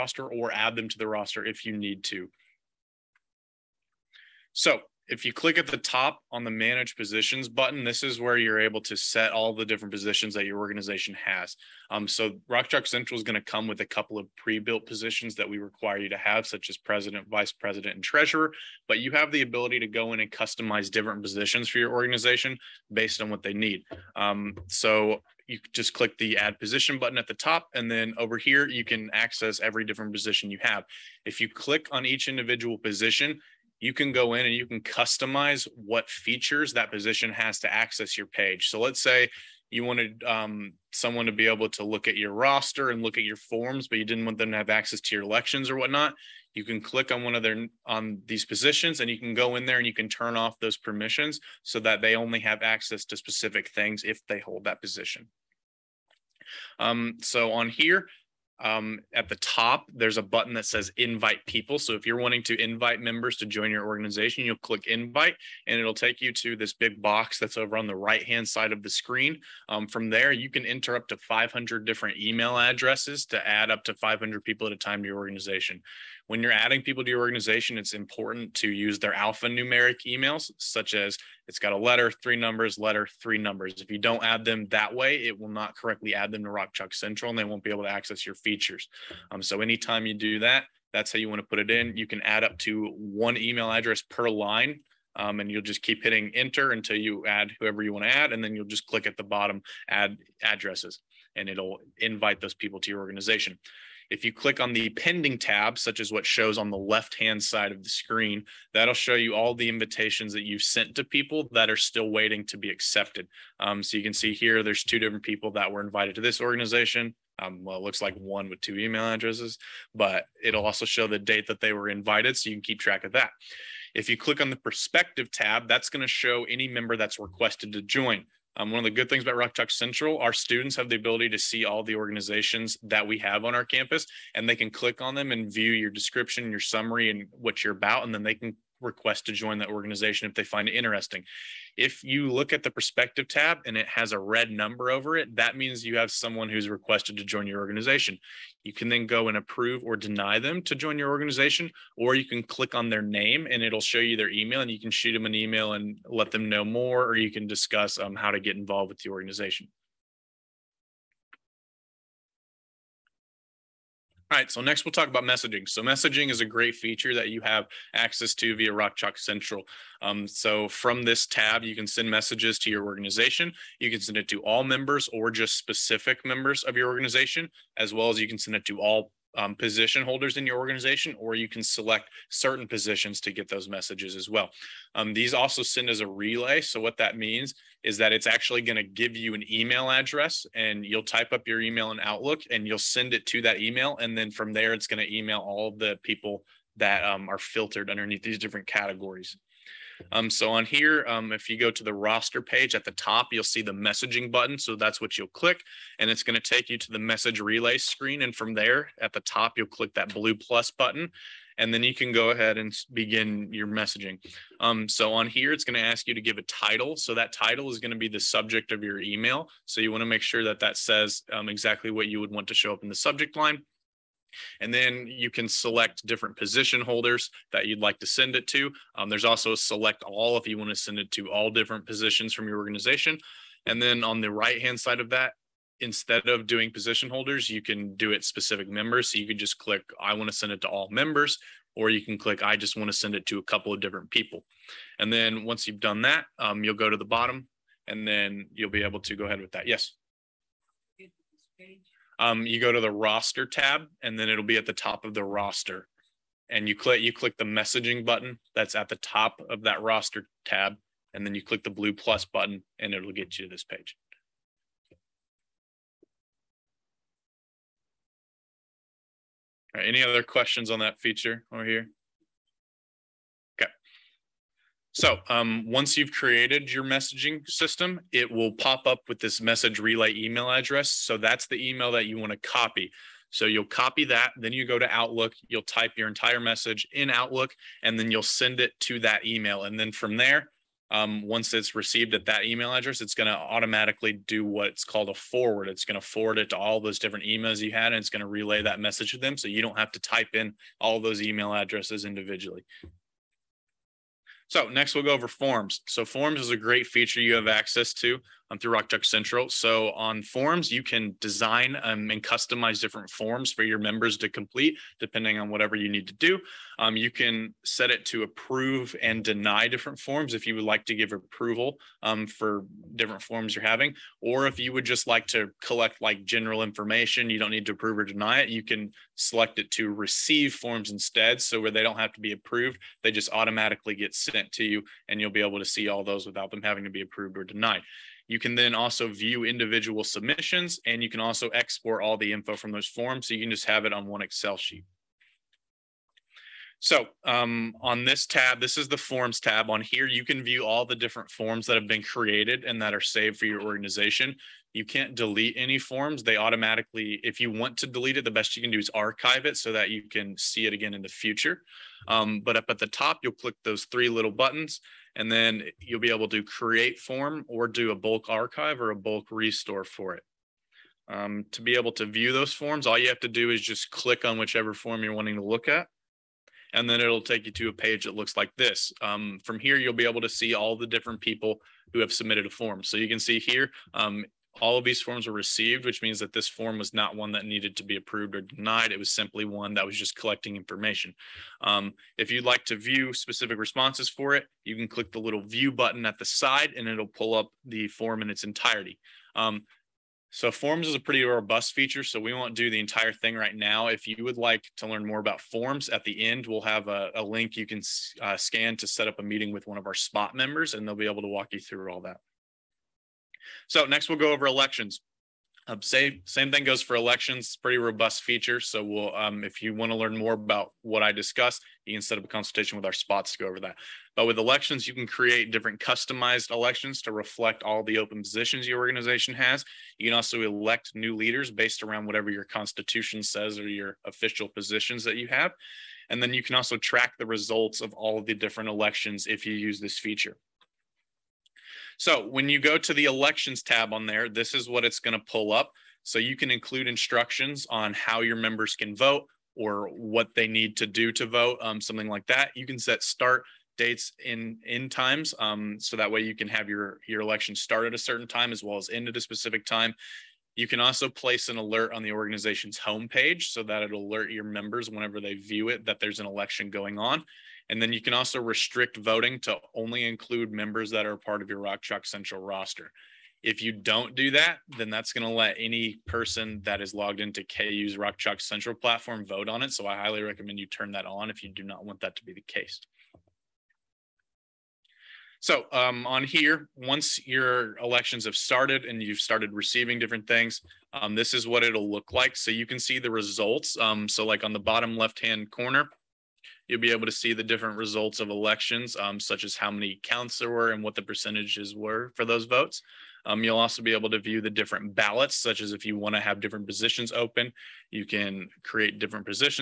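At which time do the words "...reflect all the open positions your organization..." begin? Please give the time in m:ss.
7:07.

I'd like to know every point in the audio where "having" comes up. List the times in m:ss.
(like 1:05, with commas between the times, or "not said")
5:23, 5:36.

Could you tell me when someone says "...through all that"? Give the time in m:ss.
6:51.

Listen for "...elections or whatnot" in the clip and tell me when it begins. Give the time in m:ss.
0:45.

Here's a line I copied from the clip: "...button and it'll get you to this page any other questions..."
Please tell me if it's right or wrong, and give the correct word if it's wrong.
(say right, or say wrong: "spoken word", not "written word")
right.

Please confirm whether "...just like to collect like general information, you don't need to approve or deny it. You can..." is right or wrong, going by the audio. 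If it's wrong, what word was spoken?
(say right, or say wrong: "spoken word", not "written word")
right.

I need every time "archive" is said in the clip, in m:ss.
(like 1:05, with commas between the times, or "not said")
5:58, 6:08.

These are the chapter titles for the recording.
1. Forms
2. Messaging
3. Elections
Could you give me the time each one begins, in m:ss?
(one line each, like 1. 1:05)
1. 5:25
2. 2:40
3. 6:53.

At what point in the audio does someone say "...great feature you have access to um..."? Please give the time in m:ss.
5:06.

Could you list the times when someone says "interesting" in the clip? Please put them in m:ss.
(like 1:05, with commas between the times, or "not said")
2:20.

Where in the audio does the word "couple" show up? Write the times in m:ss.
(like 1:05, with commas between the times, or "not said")
0:13, 4:03.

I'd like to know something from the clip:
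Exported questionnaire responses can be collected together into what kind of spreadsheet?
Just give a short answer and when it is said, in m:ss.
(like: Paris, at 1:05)
Excel sheet, at 5:44.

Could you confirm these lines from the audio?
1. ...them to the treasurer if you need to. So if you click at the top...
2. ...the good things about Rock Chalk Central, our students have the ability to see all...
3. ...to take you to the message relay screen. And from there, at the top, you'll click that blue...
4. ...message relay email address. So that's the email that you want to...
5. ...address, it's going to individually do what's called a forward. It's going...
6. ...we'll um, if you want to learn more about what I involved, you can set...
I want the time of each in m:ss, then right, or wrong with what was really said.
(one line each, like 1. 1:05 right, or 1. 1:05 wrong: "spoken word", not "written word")
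1. 0:00 wrong: "roster", not "treasurer"
2. 2:08 right
3. 3:26 right
4. 4:39 right
5. 4:52 wrong: "automatically", not "individually"
6. 6:58 wrong: "discussed", not "involved".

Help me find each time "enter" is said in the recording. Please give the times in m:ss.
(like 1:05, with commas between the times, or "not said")
1:10, 1:36.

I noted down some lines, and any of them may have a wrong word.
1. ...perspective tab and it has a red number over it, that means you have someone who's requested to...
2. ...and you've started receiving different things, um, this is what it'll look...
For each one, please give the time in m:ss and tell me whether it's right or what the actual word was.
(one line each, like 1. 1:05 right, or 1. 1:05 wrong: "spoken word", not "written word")
1. 2:22 right
2. 8:08 right.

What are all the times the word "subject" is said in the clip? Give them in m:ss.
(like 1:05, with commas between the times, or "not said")
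3:38, 3:42.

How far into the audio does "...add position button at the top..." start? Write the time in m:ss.
0:26.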